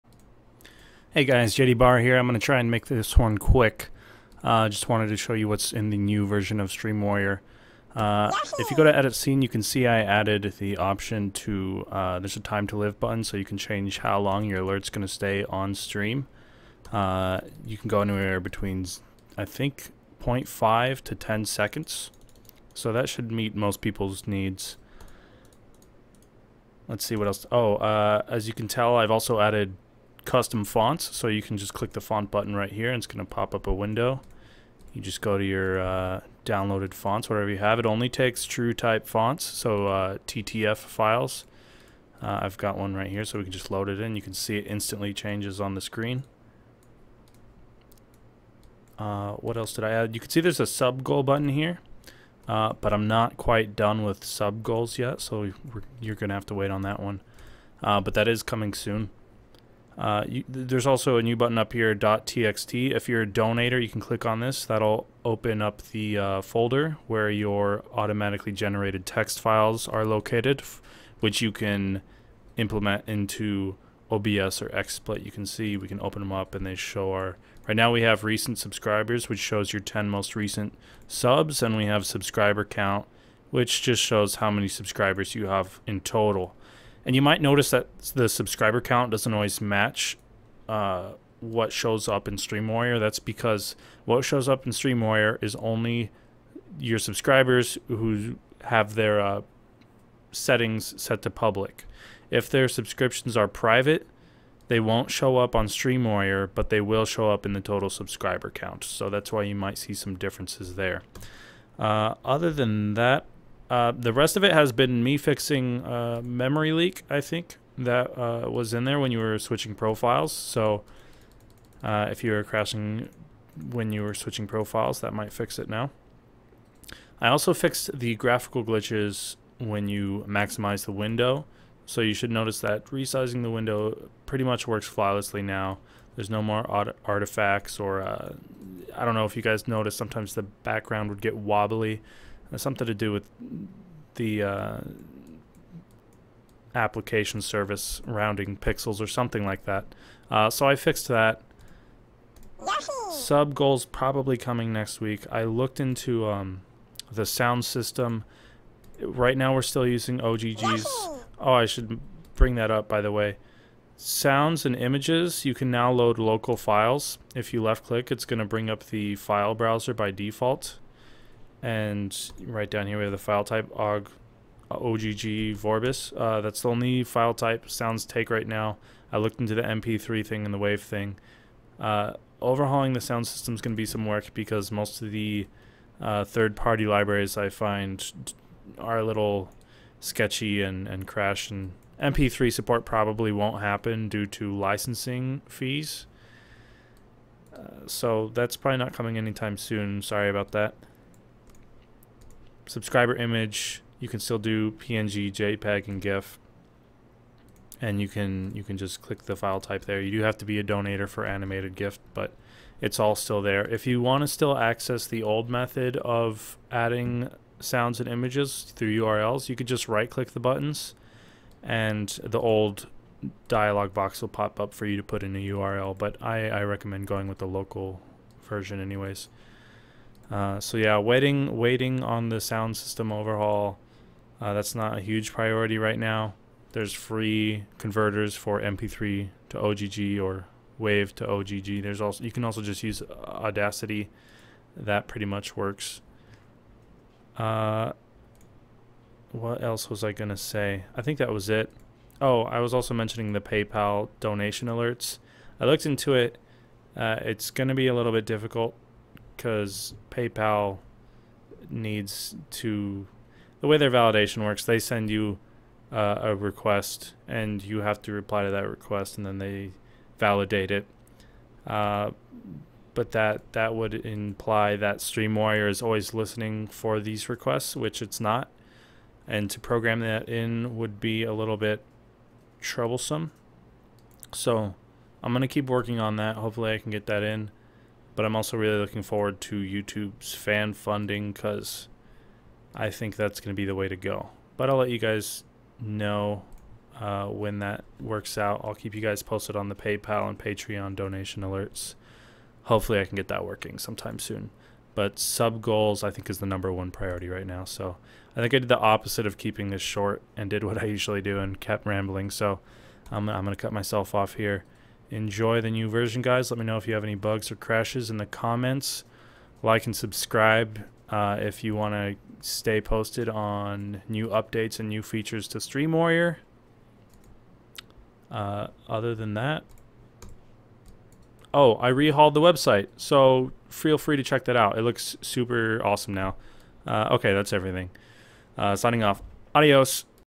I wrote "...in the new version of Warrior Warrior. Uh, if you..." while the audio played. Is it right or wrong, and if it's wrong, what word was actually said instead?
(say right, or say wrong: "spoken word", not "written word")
wrong: "Stream", not "Warrior".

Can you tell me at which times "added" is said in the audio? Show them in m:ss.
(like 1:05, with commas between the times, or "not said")
0:10, 0:29.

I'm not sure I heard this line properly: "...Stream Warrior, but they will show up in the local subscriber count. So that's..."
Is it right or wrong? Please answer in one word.
wrong.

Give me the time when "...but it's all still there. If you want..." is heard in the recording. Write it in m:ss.
3:32.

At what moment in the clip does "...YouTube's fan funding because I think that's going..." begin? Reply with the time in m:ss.
4:49.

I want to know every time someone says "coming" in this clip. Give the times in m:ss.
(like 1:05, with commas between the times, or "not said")
0:58, 2:34, 3:18.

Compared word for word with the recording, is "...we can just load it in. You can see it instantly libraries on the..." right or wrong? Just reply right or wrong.
wrong.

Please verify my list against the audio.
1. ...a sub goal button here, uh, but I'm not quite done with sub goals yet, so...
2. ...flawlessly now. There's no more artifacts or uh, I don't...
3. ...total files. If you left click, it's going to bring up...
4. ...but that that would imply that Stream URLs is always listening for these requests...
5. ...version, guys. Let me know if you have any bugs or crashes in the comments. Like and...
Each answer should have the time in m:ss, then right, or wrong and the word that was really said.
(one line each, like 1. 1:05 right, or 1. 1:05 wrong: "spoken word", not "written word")
1. 0:50 right
2. 2:14 right
3. 2:46 wrong: "local", not "total"
4. 4:32 wrong: "Warrior", not "URLs"
5. 5:15 right.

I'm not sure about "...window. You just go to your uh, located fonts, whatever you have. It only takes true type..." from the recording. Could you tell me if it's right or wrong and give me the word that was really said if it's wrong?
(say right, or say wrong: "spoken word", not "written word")
wrong: "downloaded", not "located".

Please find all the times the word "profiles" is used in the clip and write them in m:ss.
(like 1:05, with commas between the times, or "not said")
1:59, 2:04.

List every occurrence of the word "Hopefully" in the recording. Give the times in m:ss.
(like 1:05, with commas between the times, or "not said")
4:46, 5:02.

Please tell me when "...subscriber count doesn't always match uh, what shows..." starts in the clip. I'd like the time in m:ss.
1:28.